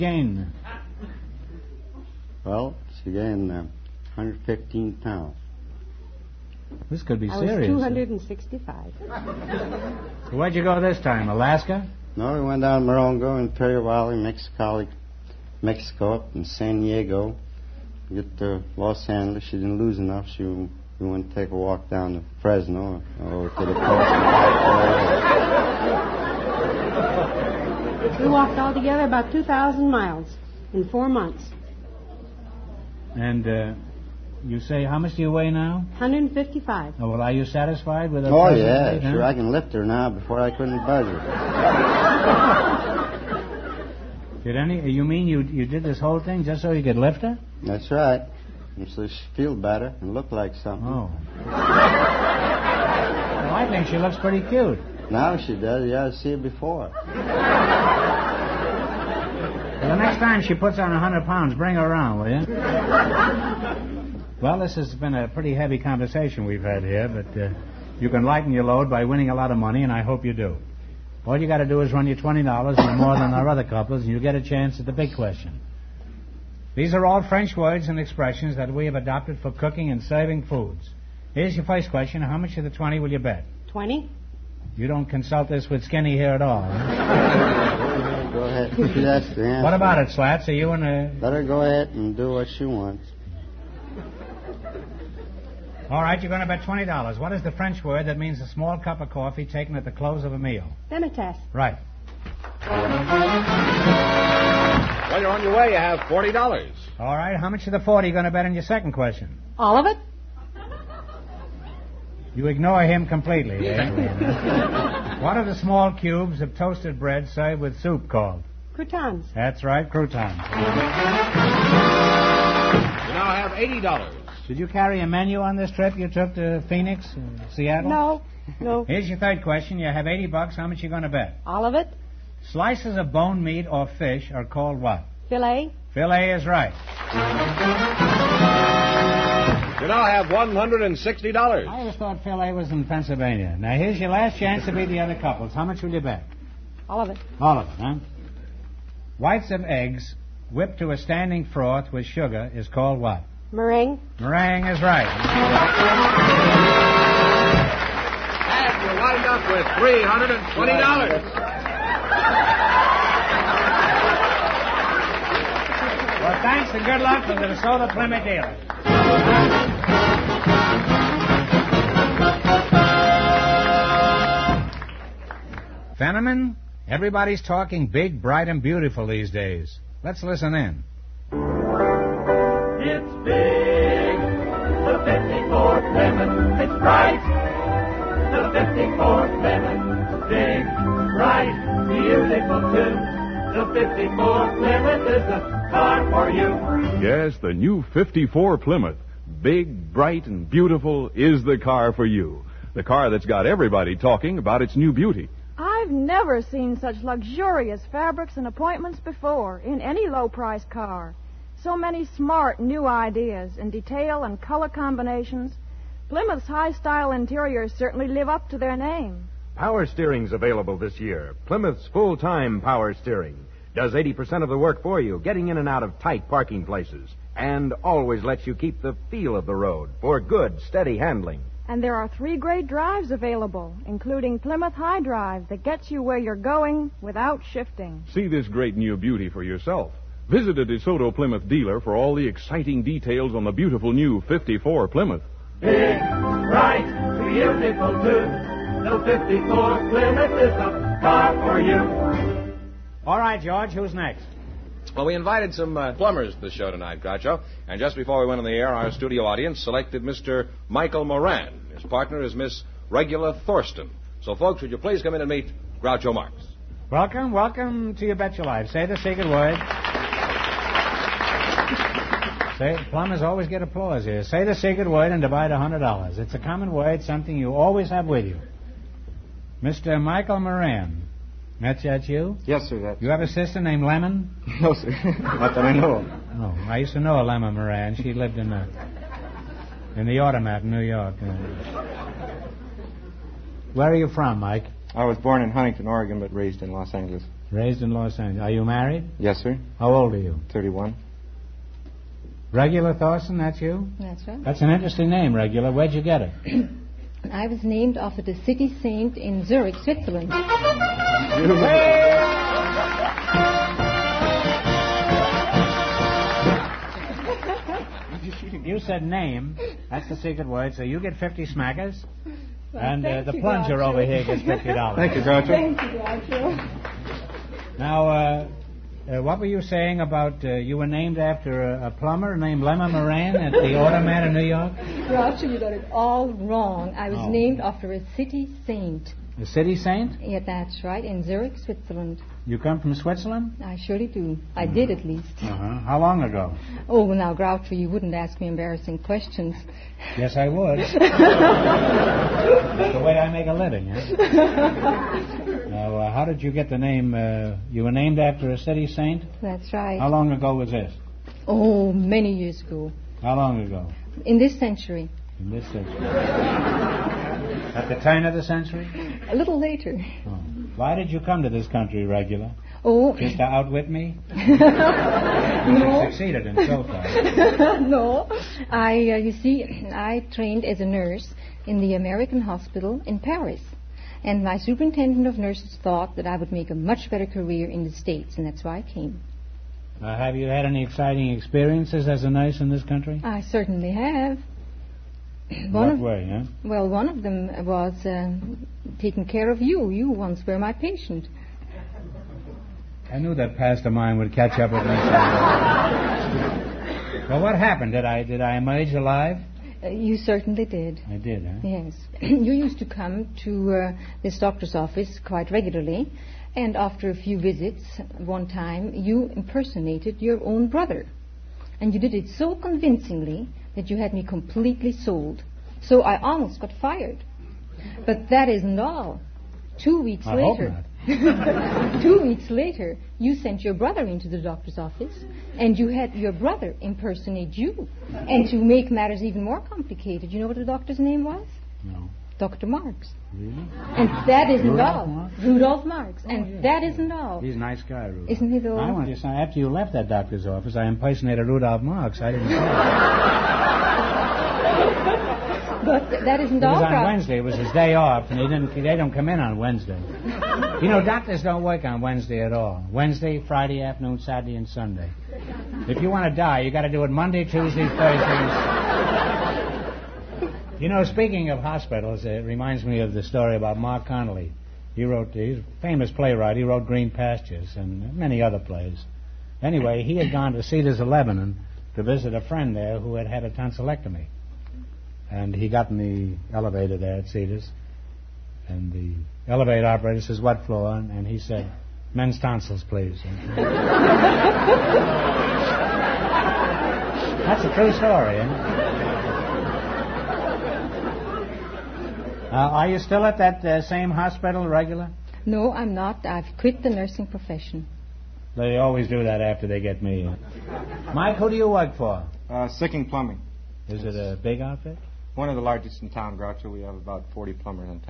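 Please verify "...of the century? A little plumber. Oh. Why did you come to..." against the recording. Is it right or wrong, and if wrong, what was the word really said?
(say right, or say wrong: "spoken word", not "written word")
wrong: "later", not "plumber".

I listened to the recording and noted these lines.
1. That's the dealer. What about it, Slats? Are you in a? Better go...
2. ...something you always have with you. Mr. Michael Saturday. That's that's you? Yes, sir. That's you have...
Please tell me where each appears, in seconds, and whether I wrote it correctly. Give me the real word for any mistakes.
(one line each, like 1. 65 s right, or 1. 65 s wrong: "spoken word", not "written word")
1. 88 s wrong: "answer", not "dealer"
2. 277 s wrong: "Moran", not "Saturday".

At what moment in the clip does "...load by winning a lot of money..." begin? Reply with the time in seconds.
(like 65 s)
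68 s.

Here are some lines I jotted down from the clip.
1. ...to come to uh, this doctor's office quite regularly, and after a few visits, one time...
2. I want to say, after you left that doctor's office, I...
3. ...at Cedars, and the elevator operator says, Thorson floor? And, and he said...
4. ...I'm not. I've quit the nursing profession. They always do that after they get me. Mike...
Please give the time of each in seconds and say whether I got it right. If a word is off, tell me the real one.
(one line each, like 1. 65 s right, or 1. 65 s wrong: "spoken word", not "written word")
1. 412 s right
2. 448 s right
3. 487 s wrong: "What", not "Thorson"
4. 505 s right.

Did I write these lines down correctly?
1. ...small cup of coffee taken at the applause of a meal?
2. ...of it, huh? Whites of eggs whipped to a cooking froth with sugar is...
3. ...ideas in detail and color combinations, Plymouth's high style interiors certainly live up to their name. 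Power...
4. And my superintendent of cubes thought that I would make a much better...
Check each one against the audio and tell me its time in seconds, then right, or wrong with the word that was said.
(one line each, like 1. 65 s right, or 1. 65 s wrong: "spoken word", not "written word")
1. 98 s wrong: "close", not "applause"
2. 147 s wrong: "standing", not "cooking"
3. 212 s right
4. 384 s wrong: "nurses", not "cubes".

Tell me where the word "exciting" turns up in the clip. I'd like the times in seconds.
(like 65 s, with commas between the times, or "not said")
242 s, 390 s.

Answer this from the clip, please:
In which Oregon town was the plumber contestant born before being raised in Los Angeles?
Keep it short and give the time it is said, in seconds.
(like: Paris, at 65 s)
Huntington, at 295 s.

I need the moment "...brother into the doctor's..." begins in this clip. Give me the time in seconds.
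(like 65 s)
433 s.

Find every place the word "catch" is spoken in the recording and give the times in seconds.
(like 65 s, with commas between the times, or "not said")
404 s.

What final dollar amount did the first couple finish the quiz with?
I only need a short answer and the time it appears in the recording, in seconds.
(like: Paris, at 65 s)
$320, at 159 s.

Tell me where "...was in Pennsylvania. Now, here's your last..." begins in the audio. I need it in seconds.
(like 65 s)
142 s.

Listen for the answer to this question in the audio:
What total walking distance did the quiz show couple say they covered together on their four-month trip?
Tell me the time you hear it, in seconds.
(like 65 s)
29 s.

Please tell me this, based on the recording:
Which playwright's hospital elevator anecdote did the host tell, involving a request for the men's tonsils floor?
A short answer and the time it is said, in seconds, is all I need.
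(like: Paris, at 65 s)
Marc Connelly, at 473 s.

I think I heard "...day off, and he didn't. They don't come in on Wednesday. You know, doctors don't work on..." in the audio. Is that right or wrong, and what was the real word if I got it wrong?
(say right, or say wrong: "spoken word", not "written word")
right.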